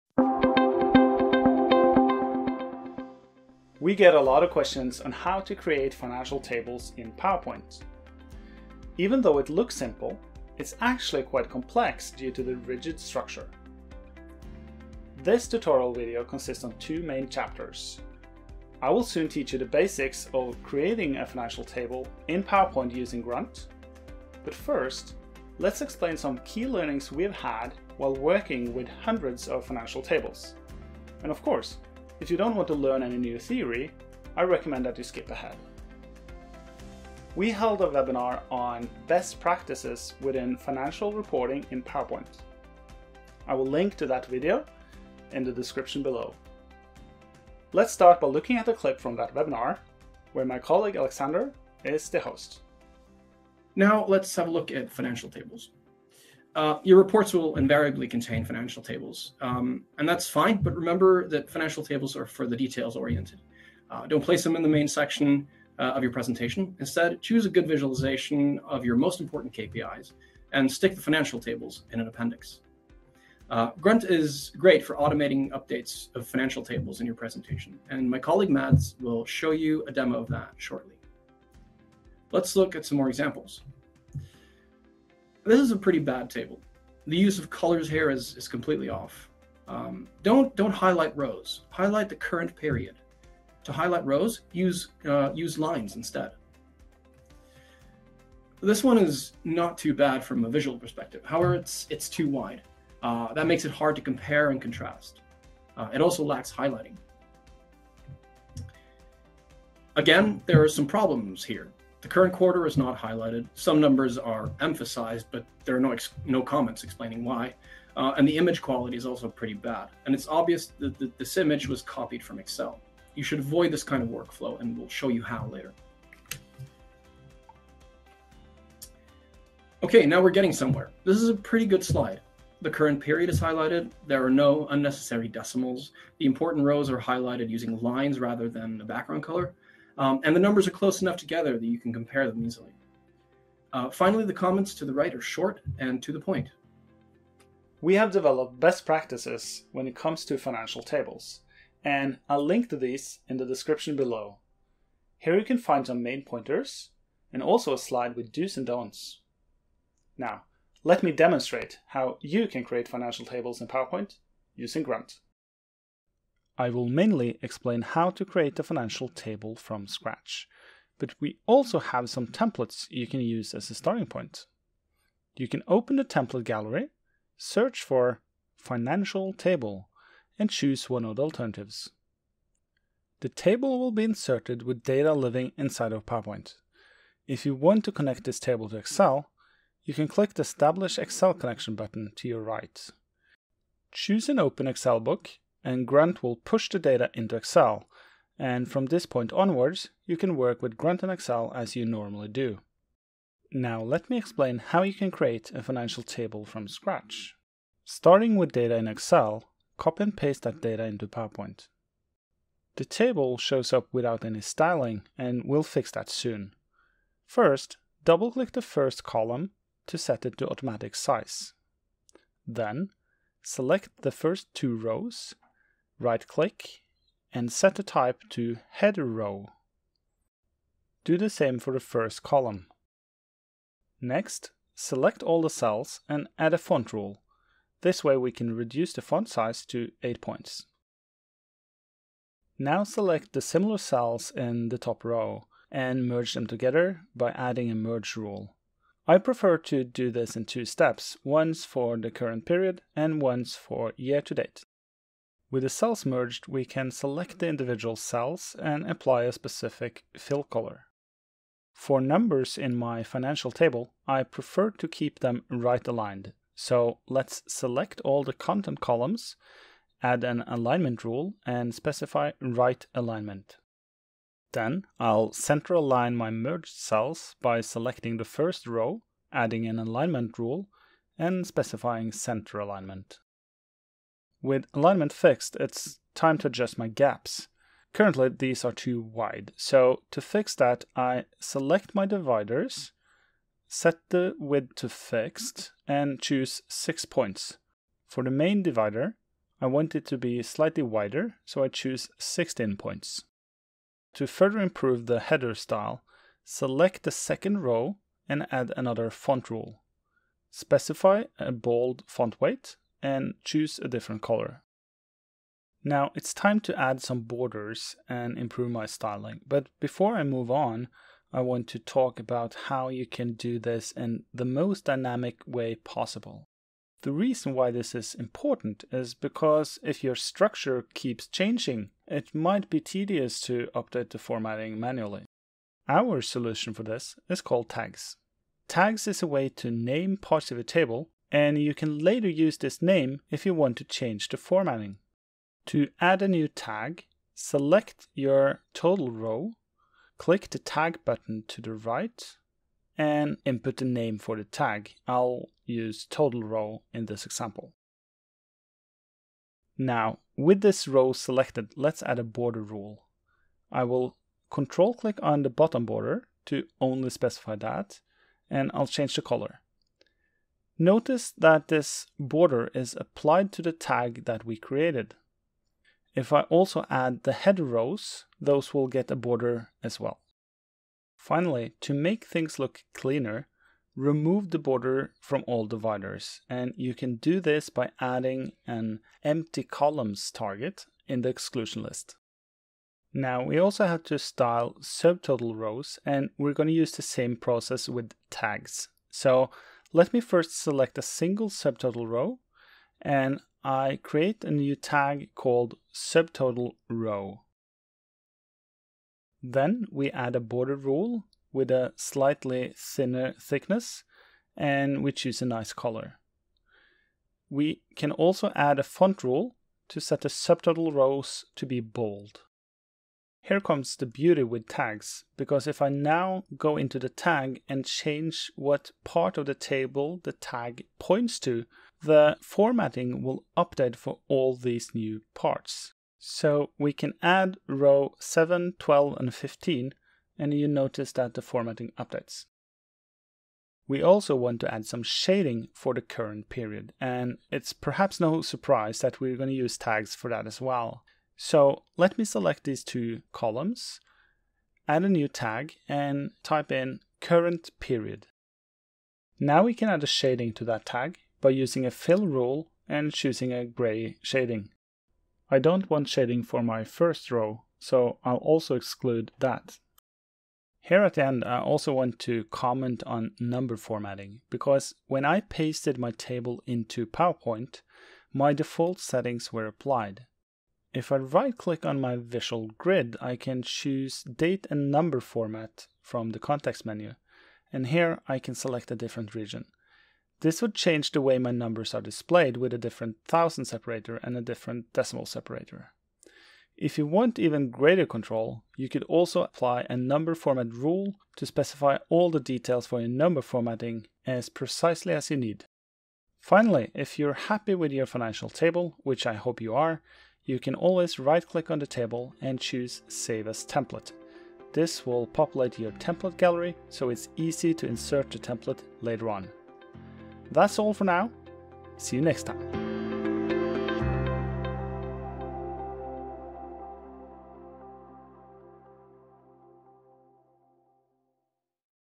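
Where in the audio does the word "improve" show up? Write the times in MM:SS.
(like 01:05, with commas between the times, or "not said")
05:04, 05:18.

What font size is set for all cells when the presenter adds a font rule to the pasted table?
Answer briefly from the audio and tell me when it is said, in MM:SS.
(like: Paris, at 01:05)
8 points, at 04:00.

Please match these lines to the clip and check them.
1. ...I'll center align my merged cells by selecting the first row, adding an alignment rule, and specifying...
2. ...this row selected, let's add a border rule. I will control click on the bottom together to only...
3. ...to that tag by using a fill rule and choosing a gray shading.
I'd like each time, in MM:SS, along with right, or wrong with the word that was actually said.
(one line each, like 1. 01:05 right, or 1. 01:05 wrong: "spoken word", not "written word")
1. 04:35 right
2. 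06:00 wrong: "border", not "together"
3. 07:40 right.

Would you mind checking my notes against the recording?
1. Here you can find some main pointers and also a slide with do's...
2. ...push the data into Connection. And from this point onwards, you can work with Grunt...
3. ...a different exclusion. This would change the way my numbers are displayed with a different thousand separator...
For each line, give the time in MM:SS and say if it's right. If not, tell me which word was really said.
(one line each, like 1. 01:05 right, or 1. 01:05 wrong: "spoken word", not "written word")
1. 02:35 right
2. 03:16 wrong: "Excel", not "Connection"
3. 08:08 wrong: "region", not "exclusion".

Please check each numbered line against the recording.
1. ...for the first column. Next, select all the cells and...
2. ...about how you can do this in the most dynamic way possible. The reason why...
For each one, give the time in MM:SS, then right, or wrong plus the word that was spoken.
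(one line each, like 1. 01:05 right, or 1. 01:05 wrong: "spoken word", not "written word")
1. 03:51 right
2. 05:22 right.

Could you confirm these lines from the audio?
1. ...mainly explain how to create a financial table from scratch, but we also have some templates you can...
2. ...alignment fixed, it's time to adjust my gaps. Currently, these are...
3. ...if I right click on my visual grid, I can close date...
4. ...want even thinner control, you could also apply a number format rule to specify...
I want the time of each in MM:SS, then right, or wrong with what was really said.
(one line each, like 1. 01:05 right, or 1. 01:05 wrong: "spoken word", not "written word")
1. 02:46 right
2. 04:44 right
3. 08:00 wrong: "choose", not "close"
4. 08:17 wrong: "greater", not "thinner".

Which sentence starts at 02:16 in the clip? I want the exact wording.
The important rows are highlighted using lines rather than the background color.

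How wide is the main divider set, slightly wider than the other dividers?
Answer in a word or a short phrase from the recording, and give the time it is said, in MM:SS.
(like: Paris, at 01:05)
16 points, at 05:02.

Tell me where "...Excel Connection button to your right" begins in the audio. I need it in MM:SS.
03:10.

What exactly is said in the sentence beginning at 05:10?
Specify a bold font weight and choose a different color.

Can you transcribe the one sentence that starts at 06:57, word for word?
We can also add a font rule to set the subtotal rows to be bold.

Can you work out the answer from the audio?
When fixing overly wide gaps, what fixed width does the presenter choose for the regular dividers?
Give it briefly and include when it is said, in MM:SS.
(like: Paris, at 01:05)
6 points, at 04:56.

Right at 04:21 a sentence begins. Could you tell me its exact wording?
For numbers in my financial table, I prefer to keep them right aligned.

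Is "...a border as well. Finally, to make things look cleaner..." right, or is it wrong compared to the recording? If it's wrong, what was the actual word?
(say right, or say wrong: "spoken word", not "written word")
right.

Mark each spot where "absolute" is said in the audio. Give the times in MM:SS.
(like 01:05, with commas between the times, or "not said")
not said.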